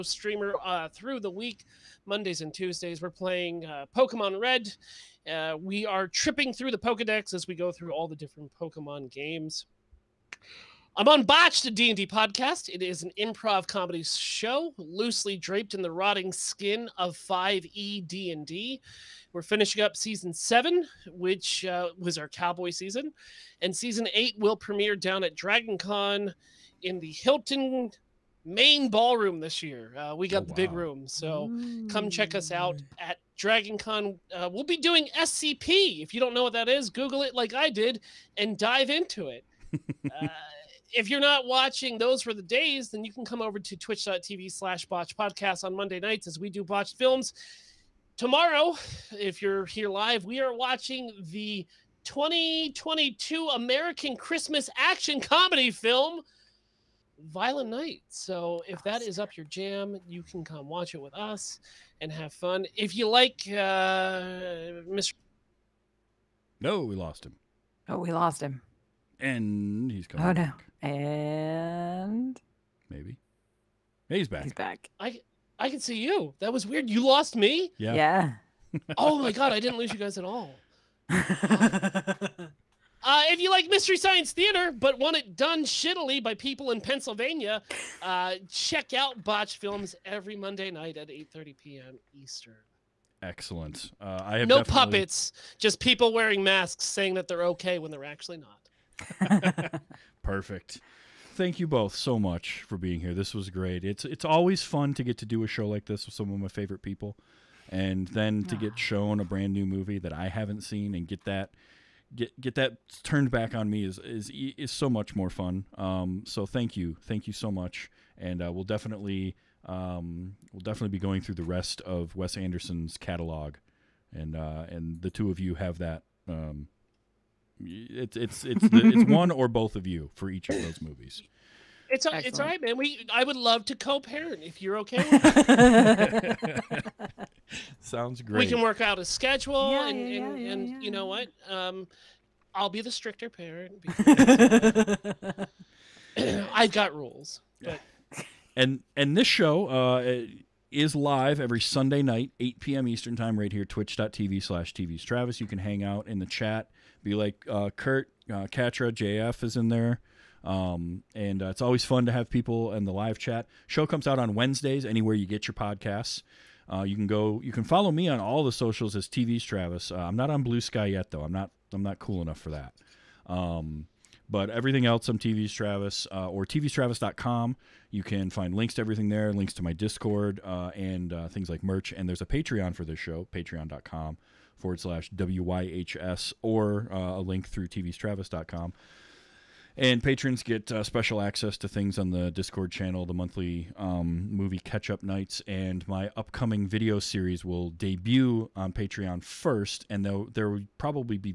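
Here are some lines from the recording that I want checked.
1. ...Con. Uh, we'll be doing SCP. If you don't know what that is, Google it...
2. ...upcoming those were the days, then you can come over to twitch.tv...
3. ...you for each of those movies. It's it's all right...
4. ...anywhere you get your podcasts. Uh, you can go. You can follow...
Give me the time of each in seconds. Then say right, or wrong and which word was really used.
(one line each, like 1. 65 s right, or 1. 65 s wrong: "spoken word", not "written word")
1. 33 s right
2. 41 s wrong: "watching", not "upcoming"
3. 129 s right
4. 164 s right.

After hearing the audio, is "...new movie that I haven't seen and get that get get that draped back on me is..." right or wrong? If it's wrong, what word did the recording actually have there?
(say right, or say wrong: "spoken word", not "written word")
wrong: "turned", not "draped".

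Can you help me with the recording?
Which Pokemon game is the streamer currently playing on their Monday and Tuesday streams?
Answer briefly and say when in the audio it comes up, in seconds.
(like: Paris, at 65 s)
Pokemon Red, at 3 s.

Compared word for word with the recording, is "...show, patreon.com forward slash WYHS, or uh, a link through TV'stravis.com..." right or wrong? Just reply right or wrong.
right.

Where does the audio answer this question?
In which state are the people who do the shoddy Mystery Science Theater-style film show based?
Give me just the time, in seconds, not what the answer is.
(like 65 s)
86 s.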